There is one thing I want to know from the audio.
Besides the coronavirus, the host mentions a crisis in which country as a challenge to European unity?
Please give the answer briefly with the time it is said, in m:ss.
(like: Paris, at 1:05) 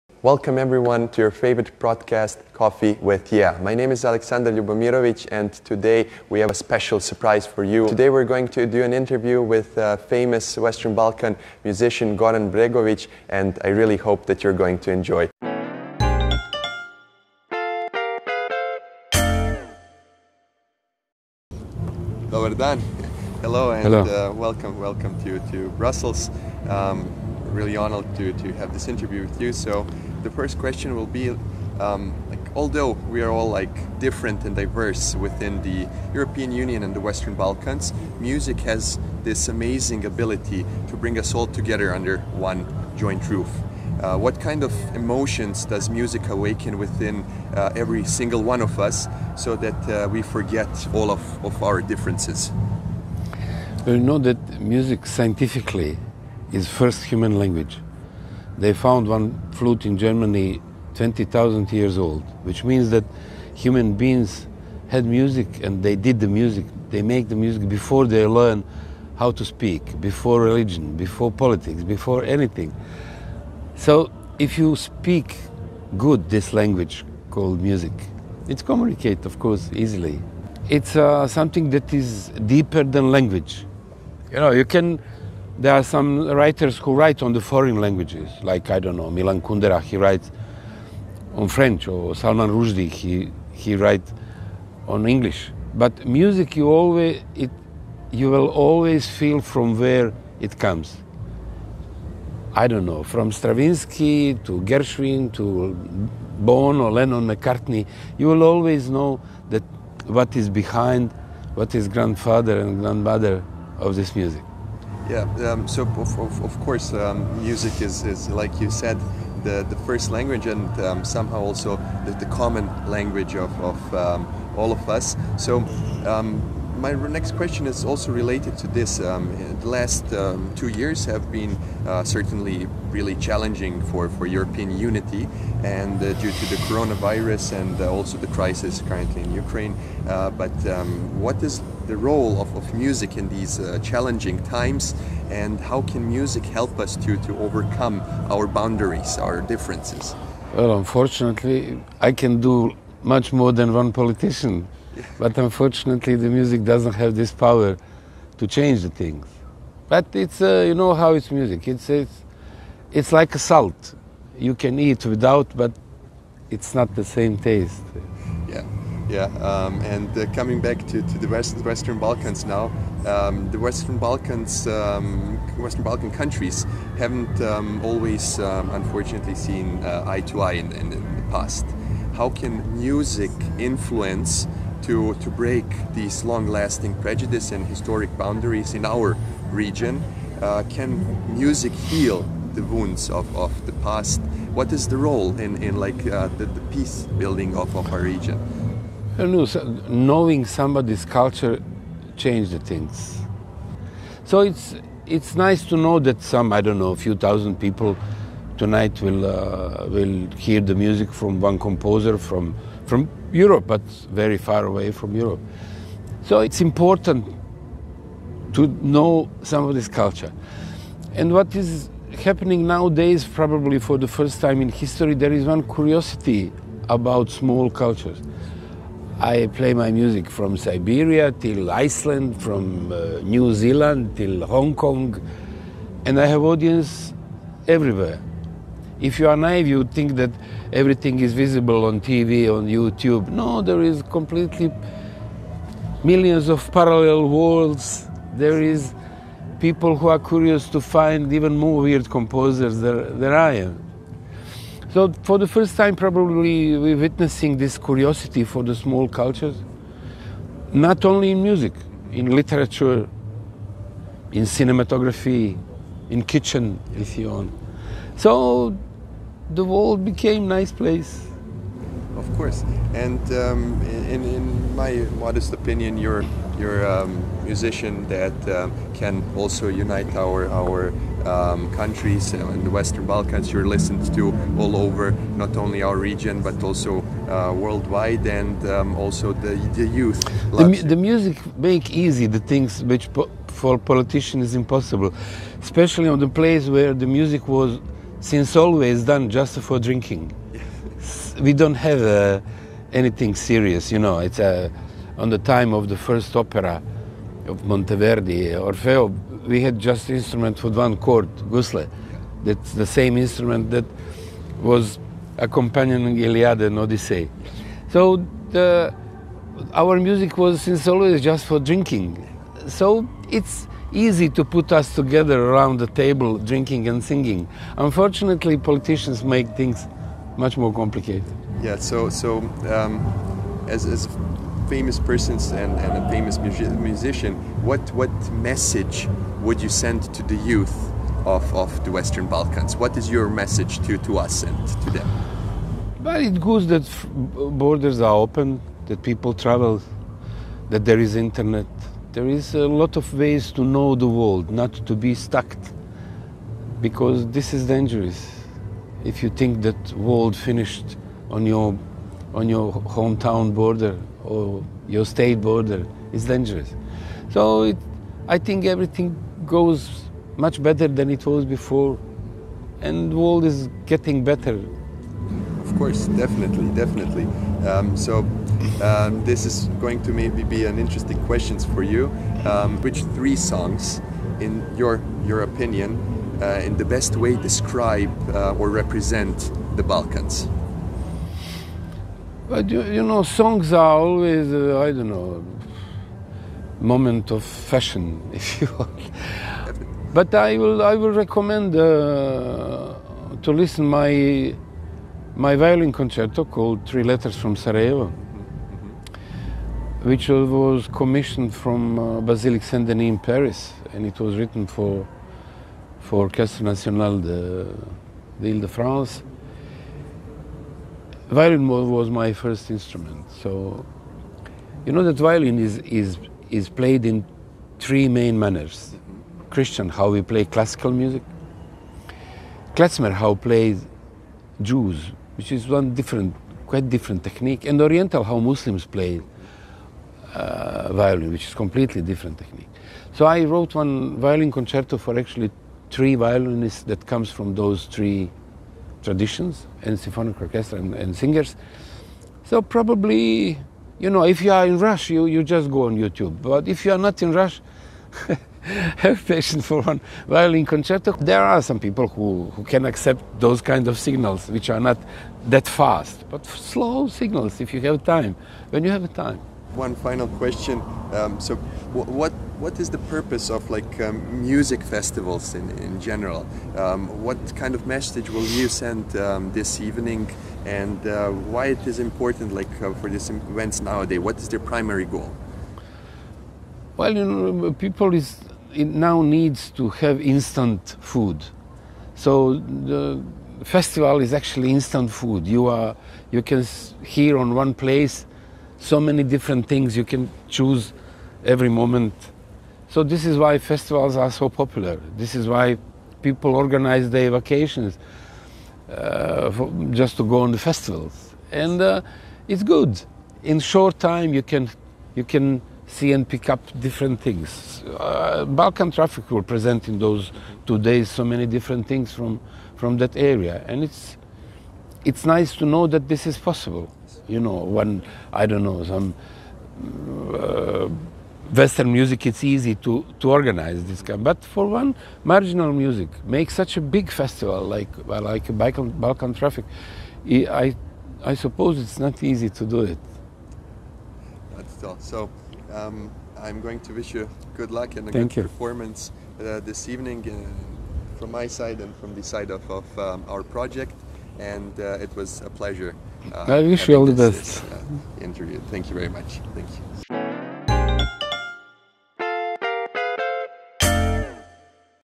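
Ukraine, at 2:19.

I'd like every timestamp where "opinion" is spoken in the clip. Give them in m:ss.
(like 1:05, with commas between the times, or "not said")
4:35, 6:25.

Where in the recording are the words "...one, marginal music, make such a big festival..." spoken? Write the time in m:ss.
8:54.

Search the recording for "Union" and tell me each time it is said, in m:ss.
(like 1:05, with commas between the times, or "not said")
0:36.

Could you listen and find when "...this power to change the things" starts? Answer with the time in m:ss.
2:37.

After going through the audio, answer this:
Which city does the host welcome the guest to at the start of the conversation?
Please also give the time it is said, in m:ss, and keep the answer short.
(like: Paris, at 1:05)
Brussels, at 0:25.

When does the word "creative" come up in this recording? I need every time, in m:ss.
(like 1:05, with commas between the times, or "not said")
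not said.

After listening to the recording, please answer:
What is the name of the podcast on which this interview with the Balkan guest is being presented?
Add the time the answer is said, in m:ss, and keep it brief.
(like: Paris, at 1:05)
Coffee with YEA, at 0:02.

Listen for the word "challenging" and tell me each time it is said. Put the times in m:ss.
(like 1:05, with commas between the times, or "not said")
2:13, 2:23.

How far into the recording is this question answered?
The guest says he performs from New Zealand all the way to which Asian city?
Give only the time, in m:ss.
3:54.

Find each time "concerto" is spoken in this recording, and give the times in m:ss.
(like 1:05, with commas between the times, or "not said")
6:45, 7:24, 7:40.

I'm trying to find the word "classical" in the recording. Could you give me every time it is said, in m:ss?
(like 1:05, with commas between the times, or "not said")
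7:10.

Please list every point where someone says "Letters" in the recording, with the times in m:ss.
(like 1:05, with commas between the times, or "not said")
6:47.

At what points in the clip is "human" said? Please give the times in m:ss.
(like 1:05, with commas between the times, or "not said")
0:57, 1:03.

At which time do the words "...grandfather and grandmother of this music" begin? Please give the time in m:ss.
1:51.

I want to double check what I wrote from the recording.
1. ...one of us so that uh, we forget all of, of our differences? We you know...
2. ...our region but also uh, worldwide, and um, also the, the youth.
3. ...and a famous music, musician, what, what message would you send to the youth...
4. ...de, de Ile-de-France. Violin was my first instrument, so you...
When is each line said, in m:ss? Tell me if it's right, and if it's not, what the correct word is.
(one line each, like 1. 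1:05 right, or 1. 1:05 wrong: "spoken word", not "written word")
1. 0:48 right
2. 4:45 right
3. 5:35 right
4. 6:57 right.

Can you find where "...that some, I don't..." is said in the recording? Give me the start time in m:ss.
3:25.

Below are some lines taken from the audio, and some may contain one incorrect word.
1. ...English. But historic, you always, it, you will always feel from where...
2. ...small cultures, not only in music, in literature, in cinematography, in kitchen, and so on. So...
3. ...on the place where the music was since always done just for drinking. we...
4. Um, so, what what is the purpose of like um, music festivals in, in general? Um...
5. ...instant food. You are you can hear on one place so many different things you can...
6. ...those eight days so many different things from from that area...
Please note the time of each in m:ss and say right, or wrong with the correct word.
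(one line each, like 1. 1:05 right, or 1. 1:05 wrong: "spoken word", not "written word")
1. 1:35 wrong: "music", not "historic"
2. 4:18 right
3. 4:56 right
4. 7:51 right
5. 8:14 right
6. 8:39 wrong: "two", not "eight".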